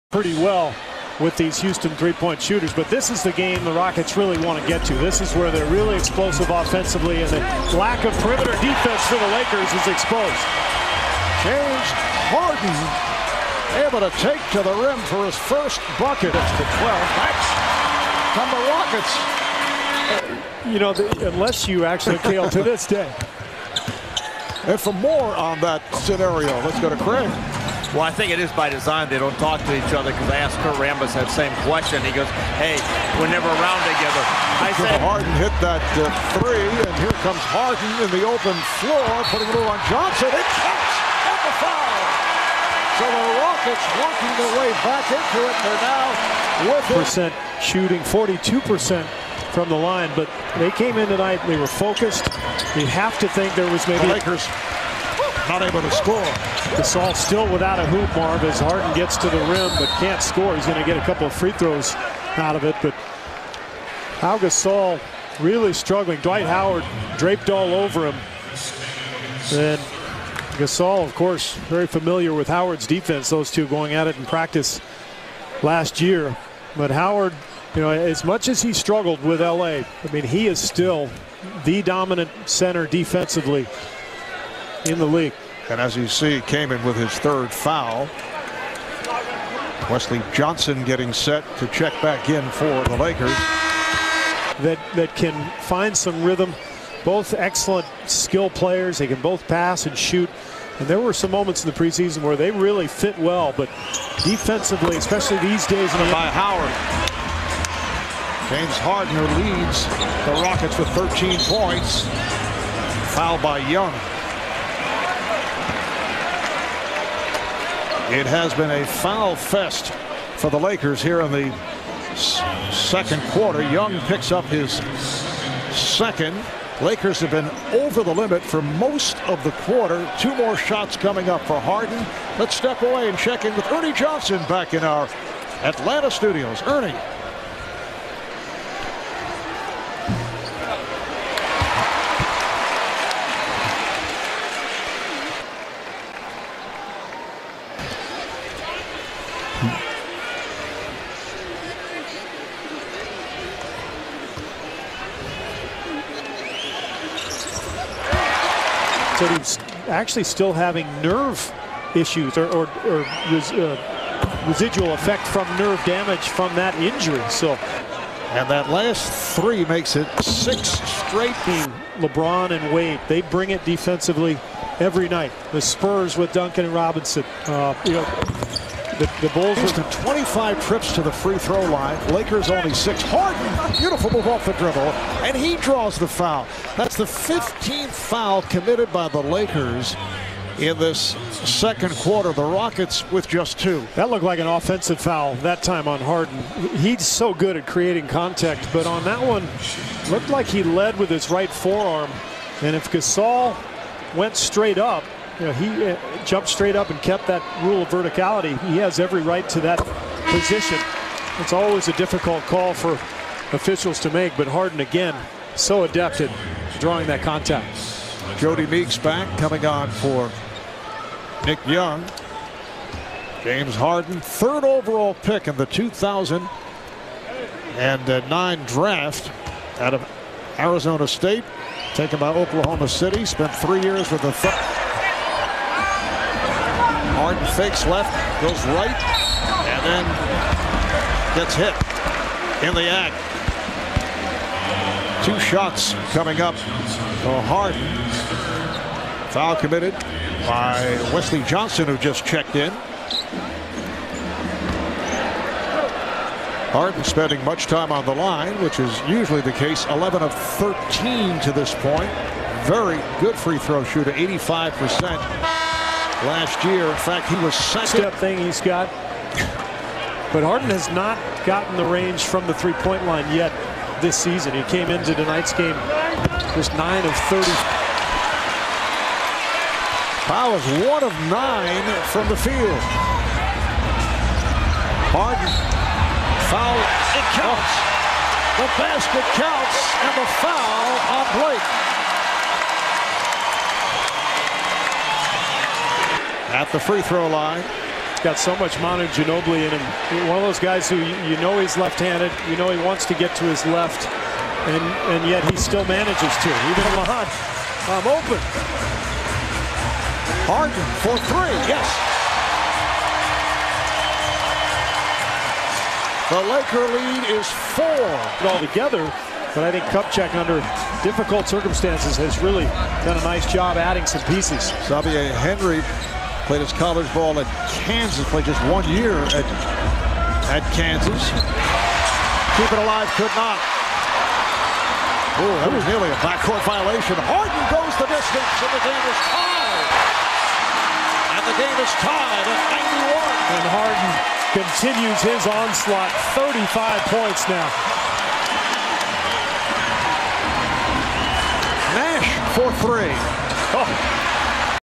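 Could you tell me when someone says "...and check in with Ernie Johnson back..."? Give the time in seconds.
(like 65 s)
133 s.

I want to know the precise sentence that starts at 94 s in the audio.
That, that can find some rhythm.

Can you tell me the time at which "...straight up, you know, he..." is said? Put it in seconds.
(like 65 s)
204 s.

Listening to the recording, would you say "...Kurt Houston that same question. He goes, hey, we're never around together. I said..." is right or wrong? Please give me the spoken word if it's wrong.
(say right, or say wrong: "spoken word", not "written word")
wrong: "Rambis", not "Houston".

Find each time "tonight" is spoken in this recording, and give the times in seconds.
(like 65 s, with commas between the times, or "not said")
51 s, 275 s.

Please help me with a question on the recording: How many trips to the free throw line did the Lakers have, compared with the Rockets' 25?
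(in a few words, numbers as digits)
6.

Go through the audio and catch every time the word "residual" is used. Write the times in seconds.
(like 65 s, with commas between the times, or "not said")
164 s.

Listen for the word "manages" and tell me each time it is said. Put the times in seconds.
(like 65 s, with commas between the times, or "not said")
305 s.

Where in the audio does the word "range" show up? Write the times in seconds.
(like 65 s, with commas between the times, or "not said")
271 s.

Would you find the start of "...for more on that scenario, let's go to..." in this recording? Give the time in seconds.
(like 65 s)
24 s.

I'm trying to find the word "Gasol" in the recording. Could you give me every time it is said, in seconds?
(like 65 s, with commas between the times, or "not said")
56 s, 64 s, 70 s, 202 s.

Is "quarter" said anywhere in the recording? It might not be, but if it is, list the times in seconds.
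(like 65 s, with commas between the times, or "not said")
123 s, 129 s, 191 s.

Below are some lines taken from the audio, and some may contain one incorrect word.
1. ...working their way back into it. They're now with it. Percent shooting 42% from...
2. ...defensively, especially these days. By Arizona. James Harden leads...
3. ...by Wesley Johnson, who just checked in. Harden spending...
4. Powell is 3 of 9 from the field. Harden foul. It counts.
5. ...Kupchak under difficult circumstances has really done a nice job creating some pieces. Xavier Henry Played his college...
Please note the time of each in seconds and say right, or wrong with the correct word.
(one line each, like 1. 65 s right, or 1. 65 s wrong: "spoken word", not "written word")
1. 43 s right
2. 104 s wrong: "Howard", not "Arizona"
3. 250 s right
4. 280 s wrong: "1", not "3"
5. 319 s wrong: "adding", not "creating".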